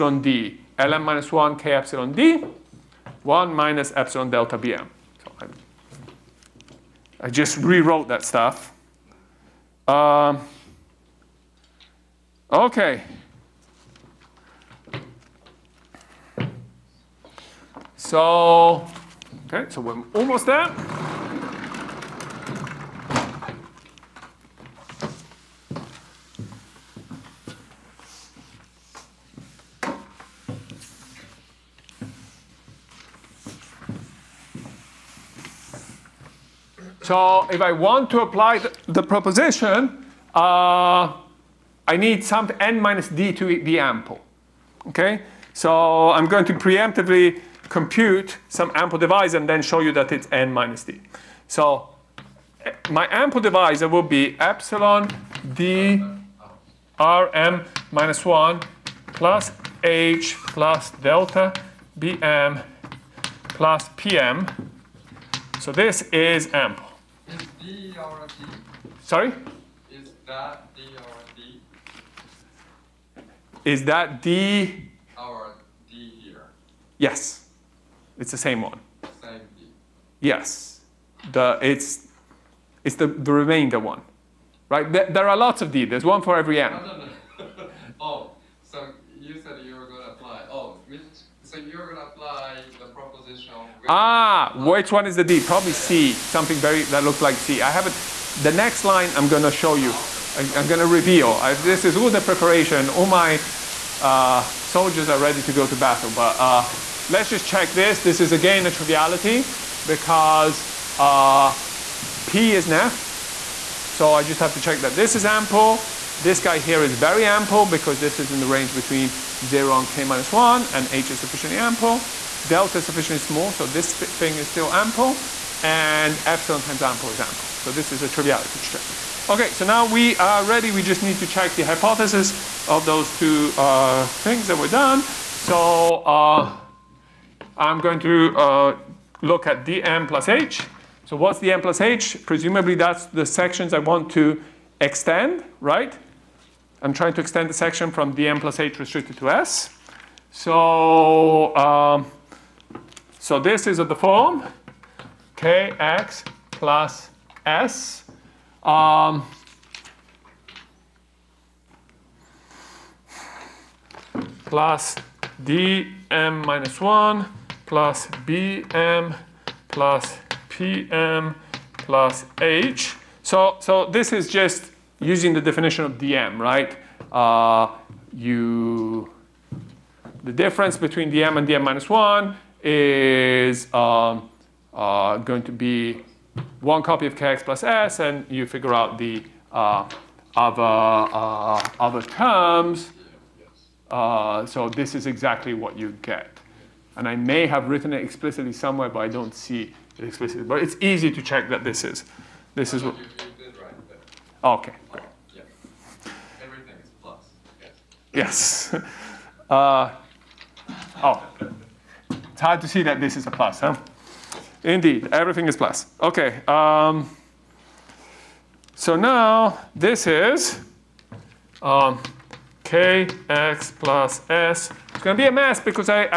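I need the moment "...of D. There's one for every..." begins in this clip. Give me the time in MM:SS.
01:25.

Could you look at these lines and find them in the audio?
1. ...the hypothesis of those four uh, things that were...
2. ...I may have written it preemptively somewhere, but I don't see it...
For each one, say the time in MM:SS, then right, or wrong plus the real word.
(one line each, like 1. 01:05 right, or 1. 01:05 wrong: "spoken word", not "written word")
1. 02:11 wrong: "two", not "four"
2. 03:17 wrong: "explicitly", not "preemptively".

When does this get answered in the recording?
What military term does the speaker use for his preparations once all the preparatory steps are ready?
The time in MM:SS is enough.
01:44.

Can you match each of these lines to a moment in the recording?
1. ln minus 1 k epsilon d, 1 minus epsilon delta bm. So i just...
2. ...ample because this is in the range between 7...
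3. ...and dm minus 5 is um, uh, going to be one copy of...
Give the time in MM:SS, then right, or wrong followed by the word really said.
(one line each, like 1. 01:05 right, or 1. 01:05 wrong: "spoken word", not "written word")
1. 00:00 right
2. 01:57 wrong: "0", not "7"
3. 03:01 wrong: "1", not "5".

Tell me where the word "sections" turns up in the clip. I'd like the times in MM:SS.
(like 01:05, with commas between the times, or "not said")
02:23, 02:27.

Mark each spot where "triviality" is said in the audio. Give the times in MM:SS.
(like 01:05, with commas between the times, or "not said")
01:48, 02:08.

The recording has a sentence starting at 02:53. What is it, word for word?
So, so this is just using the definition of dm, right?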